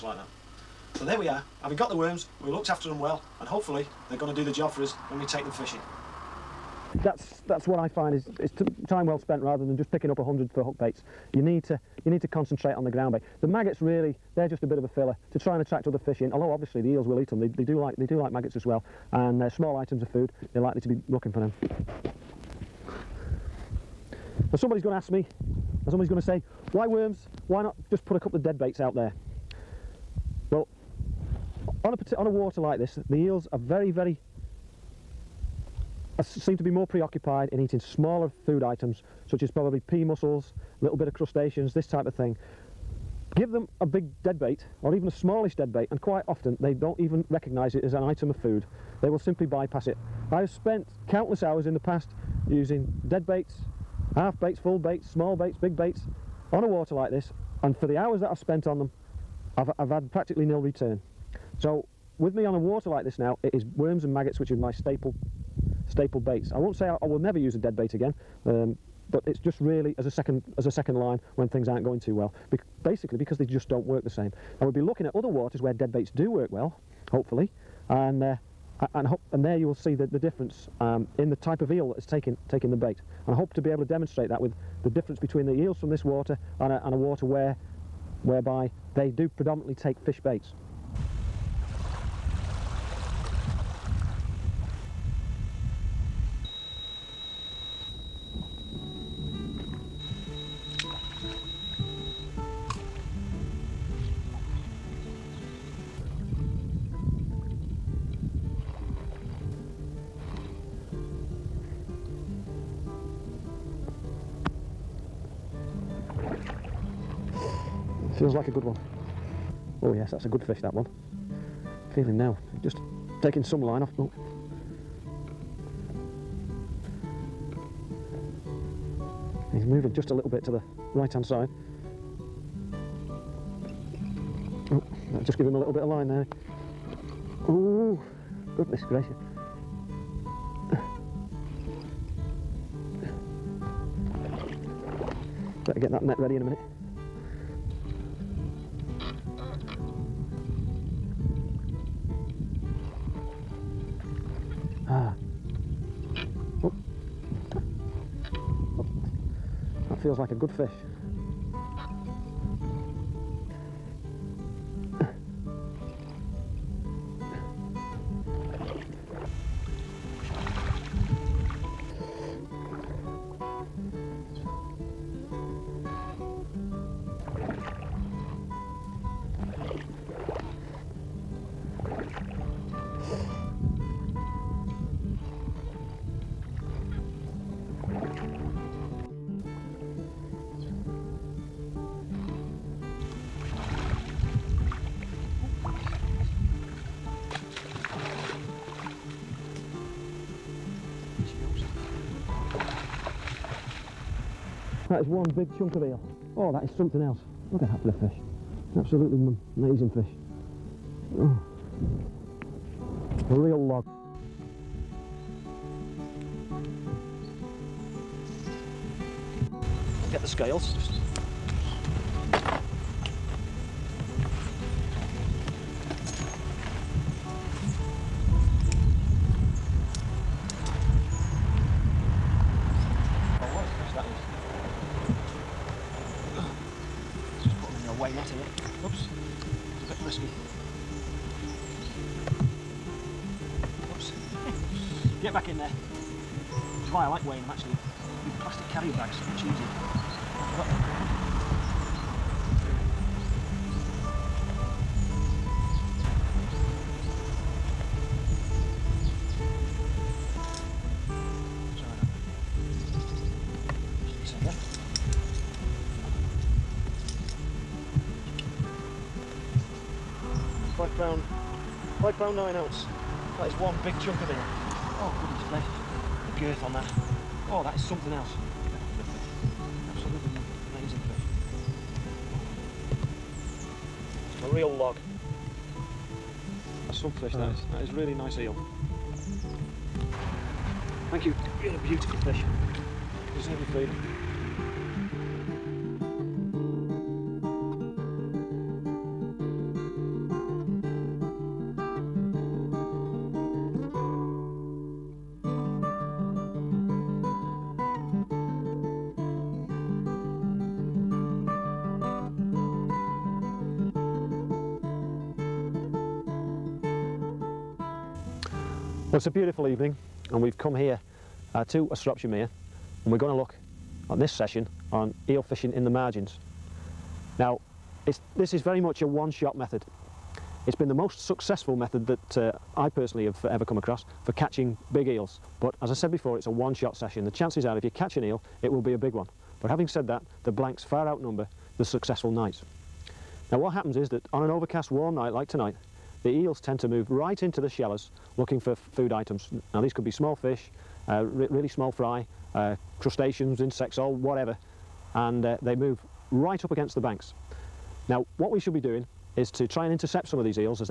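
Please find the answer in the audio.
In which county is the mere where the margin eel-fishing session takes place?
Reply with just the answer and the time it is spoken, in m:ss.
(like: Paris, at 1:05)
Shropshire, at 5:21.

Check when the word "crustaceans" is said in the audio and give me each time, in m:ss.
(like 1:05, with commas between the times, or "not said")
0:41, 5:52.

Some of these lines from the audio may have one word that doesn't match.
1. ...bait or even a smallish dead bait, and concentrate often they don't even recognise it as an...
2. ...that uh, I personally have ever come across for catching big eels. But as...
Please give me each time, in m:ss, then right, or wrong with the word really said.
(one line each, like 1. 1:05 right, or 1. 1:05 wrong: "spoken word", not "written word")
1. 0:44 wrong: "quite", not "concentrate"
2. 5:32 right.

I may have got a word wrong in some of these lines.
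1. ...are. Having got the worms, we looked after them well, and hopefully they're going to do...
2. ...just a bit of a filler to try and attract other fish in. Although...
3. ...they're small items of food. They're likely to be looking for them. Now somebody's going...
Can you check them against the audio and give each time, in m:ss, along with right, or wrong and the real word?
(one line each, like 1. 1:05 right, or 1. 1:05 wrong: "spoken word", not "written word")
1. 0:01 right
2. 0:14 right
3. 0:19 right.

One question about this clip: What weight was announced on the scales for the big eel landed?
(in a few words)
5 lb 9 oz.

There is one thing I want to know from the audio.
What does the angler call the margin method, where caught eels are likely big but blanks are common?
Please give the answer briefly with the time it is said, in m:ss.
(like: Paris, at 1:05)
one-shot method, at 5:29.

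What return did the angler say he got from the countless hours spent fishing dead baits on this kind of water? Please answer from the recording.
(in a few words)
practically nil.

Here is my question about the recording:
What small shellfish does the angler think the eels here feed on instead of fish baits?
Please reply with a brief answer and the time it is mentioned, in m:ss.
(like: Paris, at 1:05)
pea mussels, at 0:39.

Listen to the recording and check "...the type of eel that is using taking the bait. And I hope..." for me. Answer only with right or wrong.
wrong.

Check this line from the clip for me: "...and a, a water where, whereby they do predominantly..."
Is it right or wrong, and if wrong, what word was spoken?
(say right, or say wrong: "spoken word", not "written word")
right.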